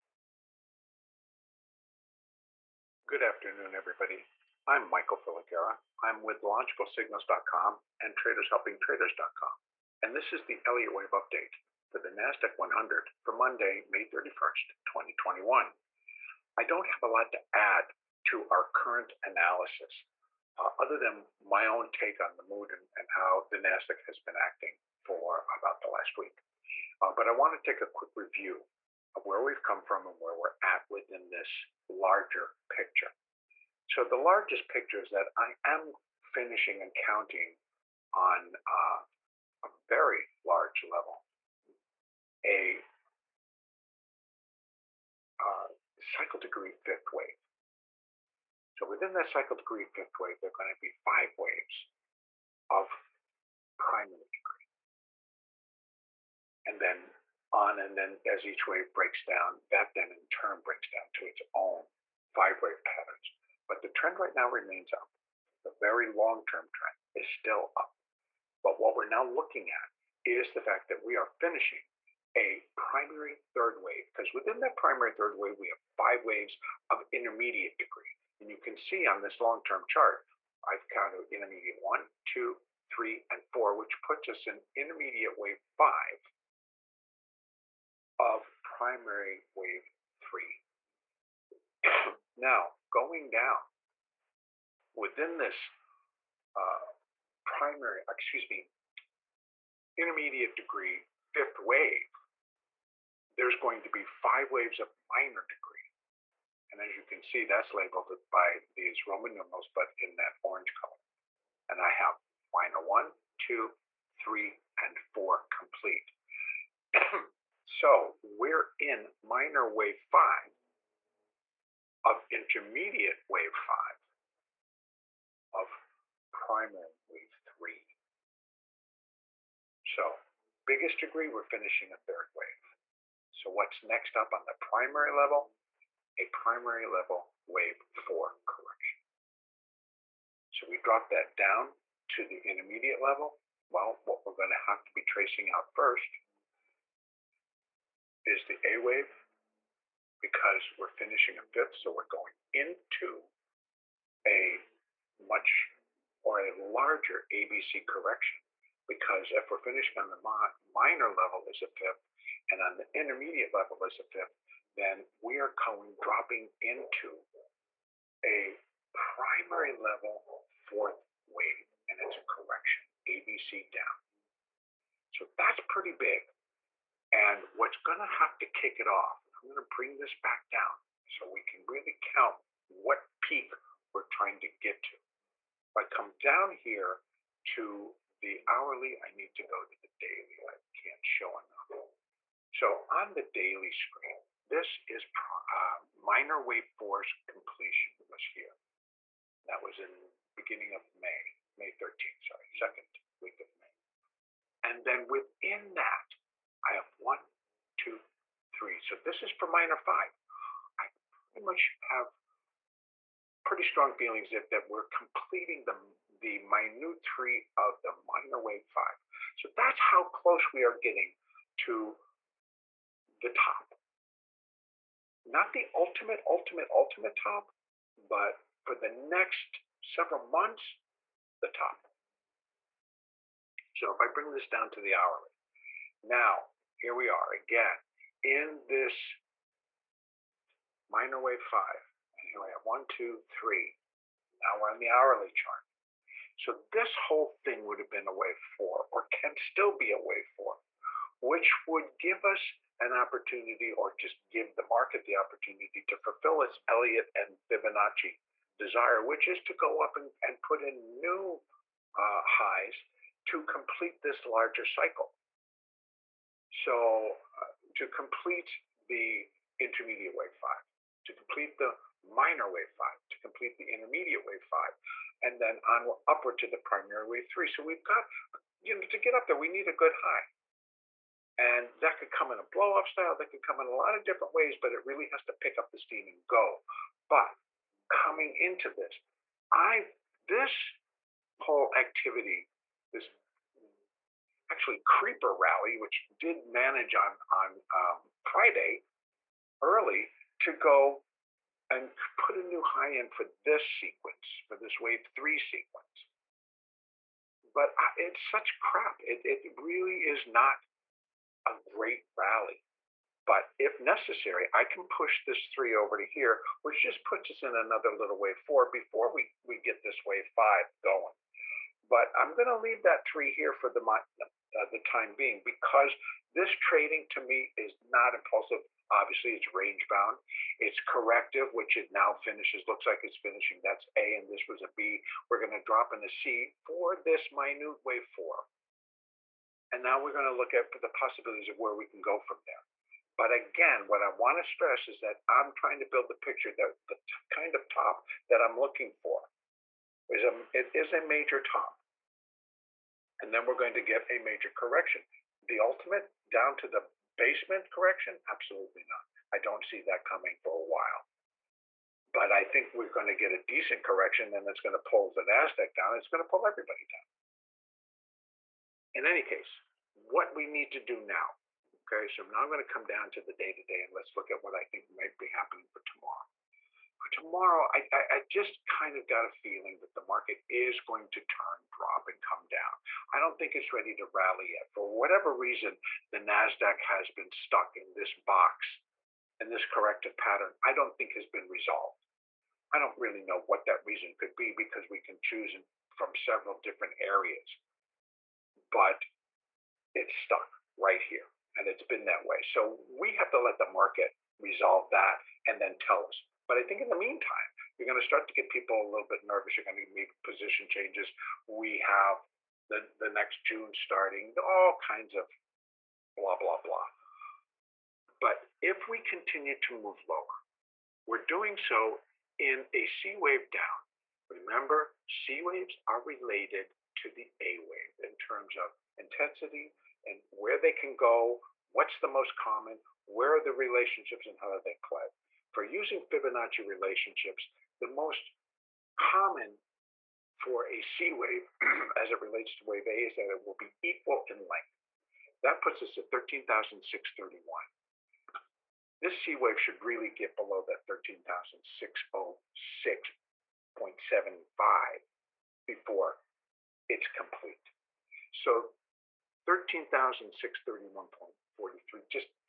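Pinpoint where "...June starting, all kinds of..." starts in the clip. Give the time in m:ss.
6:53.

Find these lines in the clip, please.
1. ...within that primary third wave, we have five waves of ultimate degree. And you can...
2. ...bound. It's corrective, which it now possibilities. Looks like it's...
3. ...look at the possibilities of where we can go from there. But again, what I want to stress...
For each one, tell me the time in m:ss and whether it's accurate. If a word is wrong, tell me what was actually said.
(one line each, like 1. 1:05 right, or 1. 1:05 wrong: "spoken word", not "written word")
1. 1:14 wrong: "intermediate", not "ultimate"
2. 5:29 wrong: "finishes", not "possibilities"
3. 5:40 right.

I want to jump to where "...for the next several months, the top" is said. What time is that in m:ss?
3:48.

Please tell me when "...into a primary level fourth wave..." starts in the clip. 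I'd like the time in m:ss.
2:46.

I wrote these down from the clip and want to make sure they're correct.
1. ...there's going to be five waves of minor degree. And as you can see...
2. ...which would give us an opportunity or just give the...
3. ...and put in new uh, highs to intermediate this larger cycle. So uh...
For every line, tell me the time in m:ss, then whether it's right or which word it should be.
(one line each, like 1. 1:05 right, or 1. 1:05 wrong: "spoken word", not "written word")
1. 1:43 right
2. 4:11 right
3. 4:20 wrong: "complete", not "intermediate".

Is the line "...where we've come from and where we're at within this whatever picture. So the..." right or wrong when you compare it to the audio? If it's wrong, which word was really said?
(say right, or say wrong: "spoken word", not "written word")
wrong: "larger", not "whatever".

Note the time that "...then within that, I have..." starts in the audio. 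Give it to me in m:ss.
3:24.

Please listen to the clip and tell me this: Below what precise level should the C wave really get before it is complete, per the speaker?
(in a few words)
13,606.75.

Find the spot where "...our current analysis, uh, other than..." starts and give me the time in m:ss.
0:18.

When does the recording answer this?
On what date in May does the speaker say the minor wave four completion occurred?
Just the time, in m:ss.
3:21.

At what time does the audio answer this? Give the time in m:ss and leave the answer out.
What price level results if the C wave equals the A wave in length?
7:26.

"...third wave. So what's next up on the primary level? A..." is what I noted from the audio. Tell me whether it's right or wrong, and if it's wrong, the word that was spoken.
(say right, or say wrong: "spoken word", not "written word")
right.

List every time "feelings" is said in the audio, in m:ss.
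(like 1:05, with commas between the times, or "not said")
3:33, 6:19.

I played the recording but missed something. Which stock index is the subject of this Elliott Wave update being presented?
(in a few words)
NASDAQ 100.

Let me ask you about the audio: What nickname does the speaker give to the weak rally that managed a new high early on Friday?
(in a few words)
Creeper Rally.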